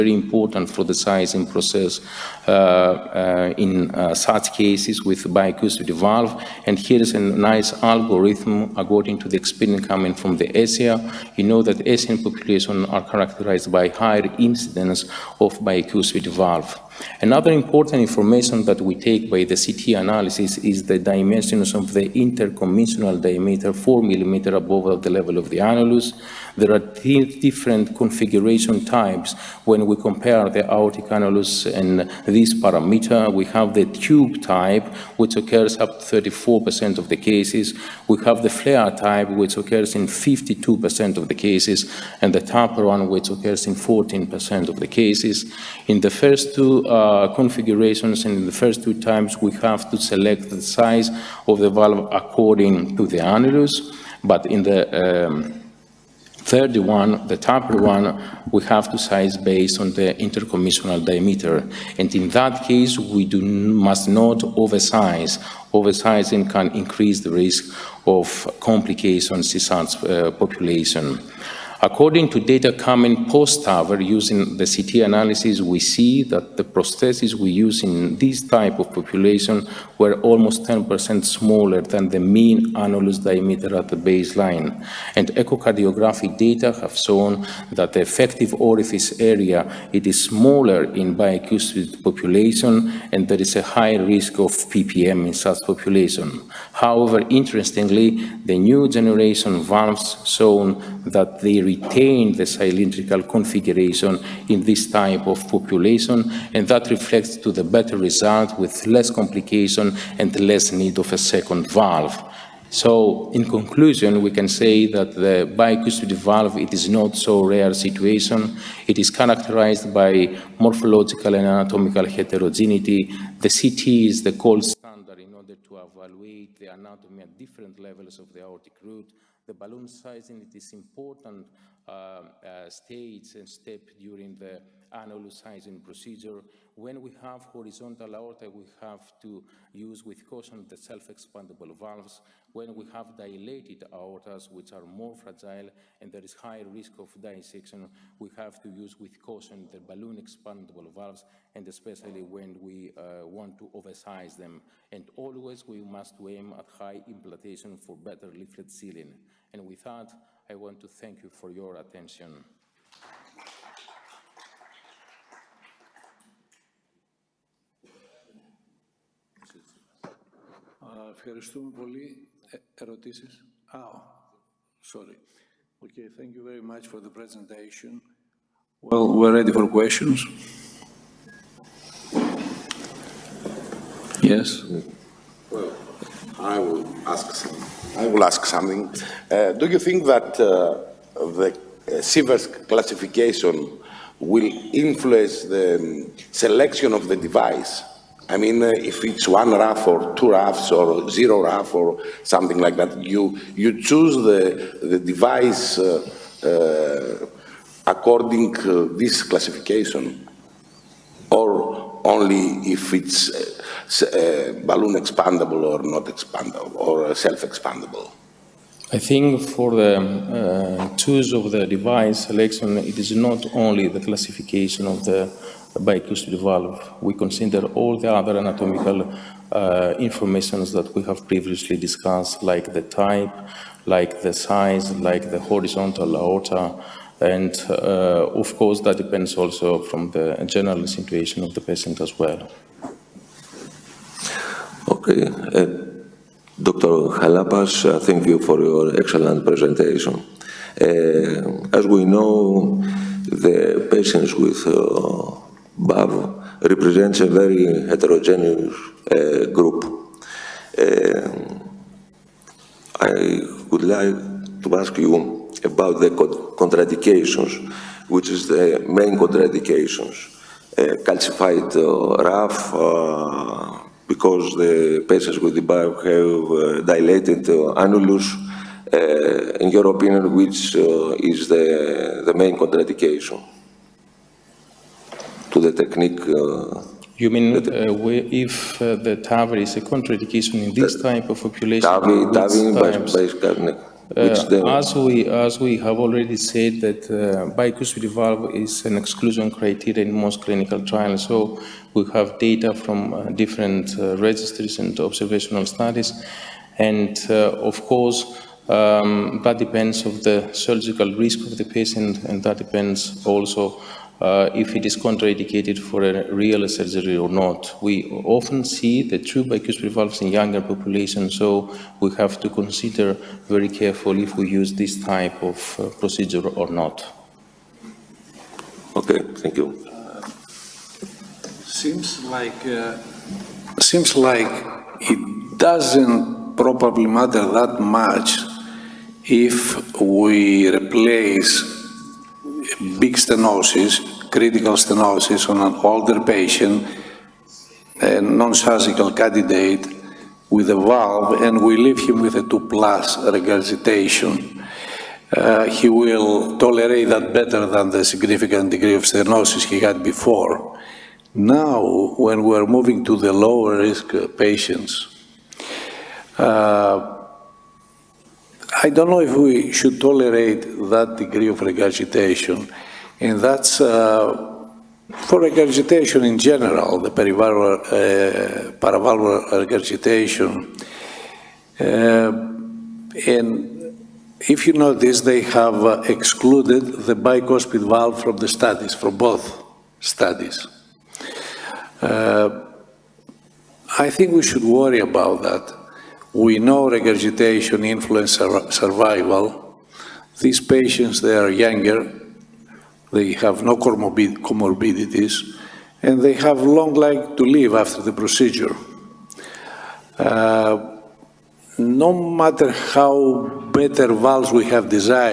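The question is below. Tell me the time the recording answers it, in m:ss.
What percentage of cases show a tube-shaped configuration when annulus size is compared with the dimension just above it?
0:36.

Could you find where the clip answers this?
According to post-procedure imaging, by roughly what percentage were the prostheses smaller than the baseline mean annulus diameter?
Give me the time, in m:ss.
1:20.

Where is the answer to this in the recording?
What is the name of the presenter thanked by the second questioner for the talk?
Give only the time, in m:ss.
4:06.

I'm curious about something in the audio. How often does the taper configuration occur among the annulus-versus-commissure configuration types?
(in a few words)
14%.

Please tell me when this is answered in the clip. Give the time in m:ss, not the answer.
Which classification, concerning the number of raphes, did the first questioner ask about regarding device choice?
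3:12.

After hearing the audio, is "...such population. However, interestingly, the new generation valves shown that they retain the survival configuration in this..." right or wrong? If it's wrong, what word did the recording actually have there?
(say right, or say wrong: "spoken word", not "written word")
wrong: "cylindrical", not "survival".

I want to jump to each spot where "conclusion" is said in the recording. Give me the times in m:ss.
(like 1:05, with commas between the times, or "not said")
1:53.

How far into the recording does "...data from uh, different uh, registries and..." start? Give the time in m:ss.
5:02.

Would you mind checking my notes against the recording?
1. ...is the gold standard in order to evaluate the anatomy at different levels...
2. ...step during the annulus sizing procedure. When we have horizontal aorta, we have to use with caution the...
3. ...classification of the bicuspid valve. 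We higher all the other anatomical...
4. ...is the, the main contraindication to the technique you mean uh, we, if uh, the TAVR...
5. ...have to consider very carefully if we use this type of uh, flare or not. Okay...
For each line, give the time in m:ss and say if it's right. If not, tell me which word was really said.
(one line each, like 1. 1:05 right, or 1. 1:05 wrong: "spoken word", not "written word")
1. 2:04 right
2. 2:13 right
3. 3:43 wrong: "consider", not "higher"
4. 4:41 right
5. 5:22 wrong: "procedure", not "flare".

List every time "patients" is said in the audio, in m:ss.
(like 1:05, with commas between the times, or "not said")
4:01, 4:13, 4:35, 5:11, 5:46, 6:04, 6:40.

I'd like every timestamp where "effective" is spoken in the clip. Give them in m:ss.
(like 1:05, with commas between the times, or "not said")
1:28.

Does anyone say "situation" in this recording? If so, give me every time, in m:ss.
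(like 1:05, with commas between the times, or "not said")
1:57, 4:00.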